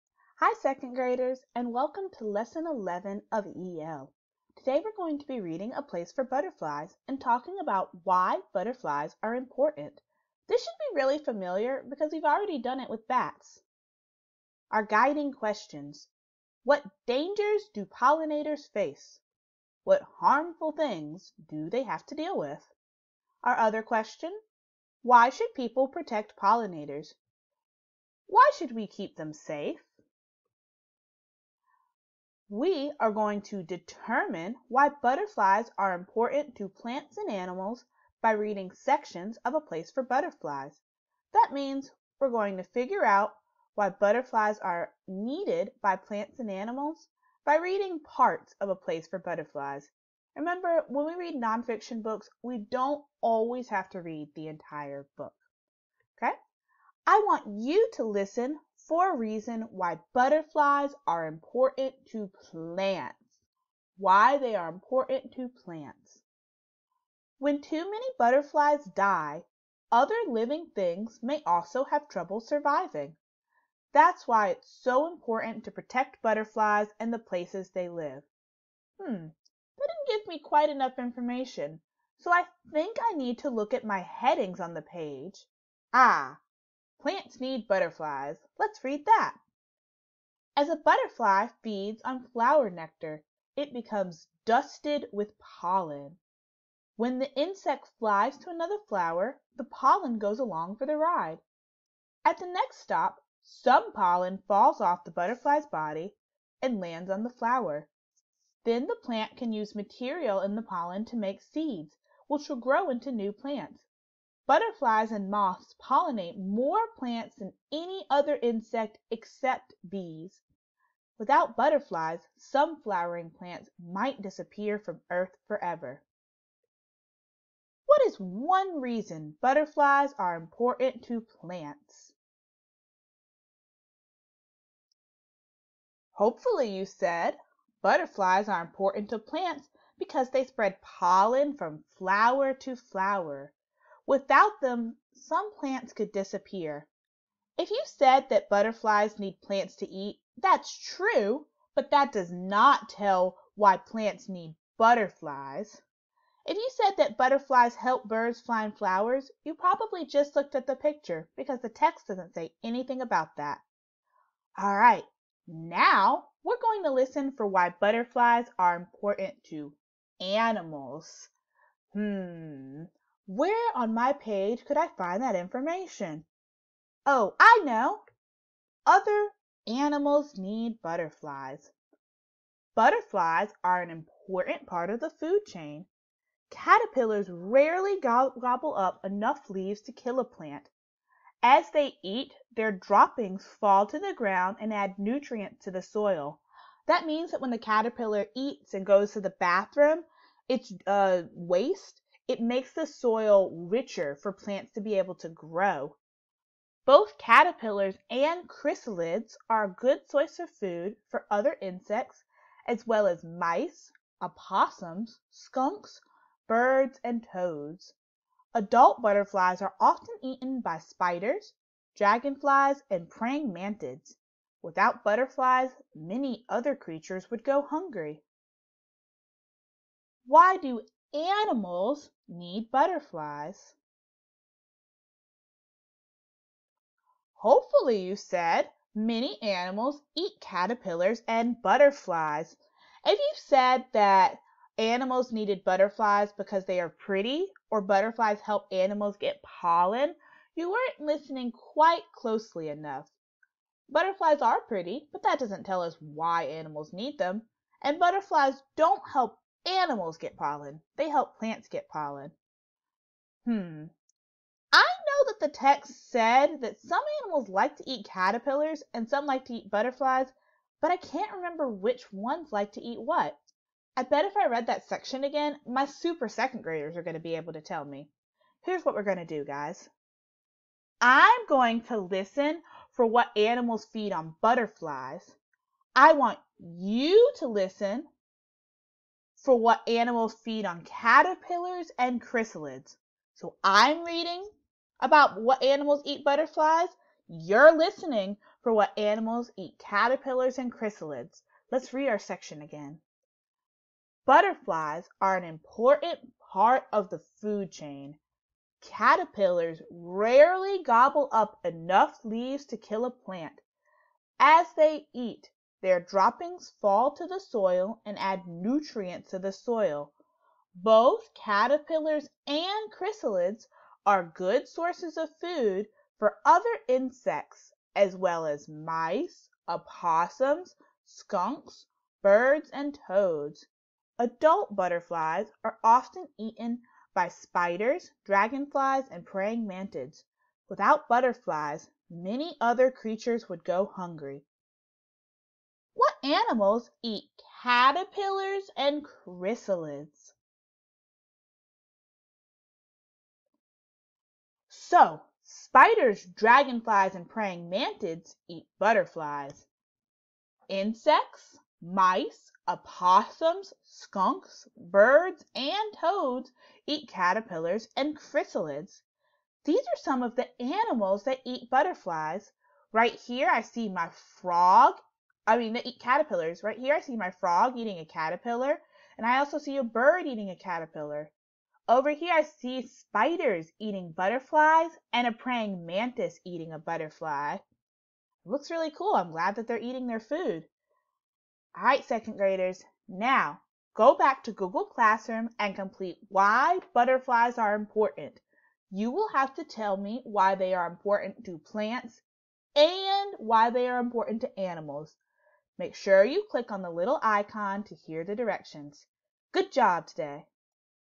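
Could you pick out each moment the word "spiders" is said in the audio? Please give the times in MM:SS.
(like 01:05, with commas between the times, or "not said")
03:40, 05:37, 05:55, 06:22.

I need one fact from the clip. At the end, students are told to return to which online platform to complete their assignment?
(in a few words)
Google Classroom.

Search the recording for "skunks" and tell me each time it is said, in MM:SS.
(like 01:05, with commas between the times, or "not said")
03:35, 05:31, 06:03.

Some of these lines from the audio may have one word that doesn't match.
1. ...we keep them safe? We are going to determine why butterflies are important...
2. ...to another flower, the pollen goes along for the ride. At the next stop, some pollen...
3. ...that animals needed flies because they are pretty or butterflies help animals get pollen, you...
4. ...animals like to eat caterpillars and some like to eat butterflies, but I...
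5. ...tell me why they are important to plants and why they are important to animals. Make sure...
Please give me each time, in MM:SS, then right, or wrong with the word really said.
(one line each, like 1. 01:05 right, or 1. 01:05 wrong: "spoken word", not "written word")
1. 00:28 right
2. 01:38 right
3. 04:03 wrong: "butterflies", not "flies"
4. 04:27 right
5. 06:39 right.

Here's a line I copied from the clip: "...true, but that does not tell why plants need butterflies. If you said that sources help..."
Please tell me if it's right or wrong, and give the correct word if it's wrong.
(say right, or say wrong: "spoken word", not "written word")
wrong: "butterflies", not "sources".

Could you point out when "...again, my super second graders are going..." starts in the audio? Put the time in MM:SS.
04:35.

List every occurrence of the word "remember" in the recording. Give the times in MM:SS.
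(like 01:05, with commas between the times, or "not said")
00:50, 04:31.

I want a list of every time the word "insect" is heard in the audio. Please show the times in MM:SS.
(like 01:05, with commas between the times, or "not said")
01:37, 01:58, 03:31, 05:26, 06:00.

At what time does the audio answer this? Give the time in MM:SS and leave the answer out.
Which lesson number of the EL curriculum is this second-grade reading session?
00:02.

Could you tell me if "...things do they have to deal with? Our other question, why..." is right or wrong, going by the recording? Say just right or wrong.
right.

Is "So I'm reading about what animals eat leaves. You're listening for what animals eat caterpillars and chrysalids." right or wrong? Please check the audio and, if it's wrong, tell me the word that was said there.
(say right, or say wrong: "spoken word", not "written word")
wrong: "butterflies", not "leaves".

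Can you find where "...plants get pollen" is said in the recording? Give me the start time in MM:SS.
04:21.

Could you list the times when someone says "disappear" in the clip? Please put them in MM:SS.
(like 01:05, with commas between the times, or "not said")
02:04, 02:26.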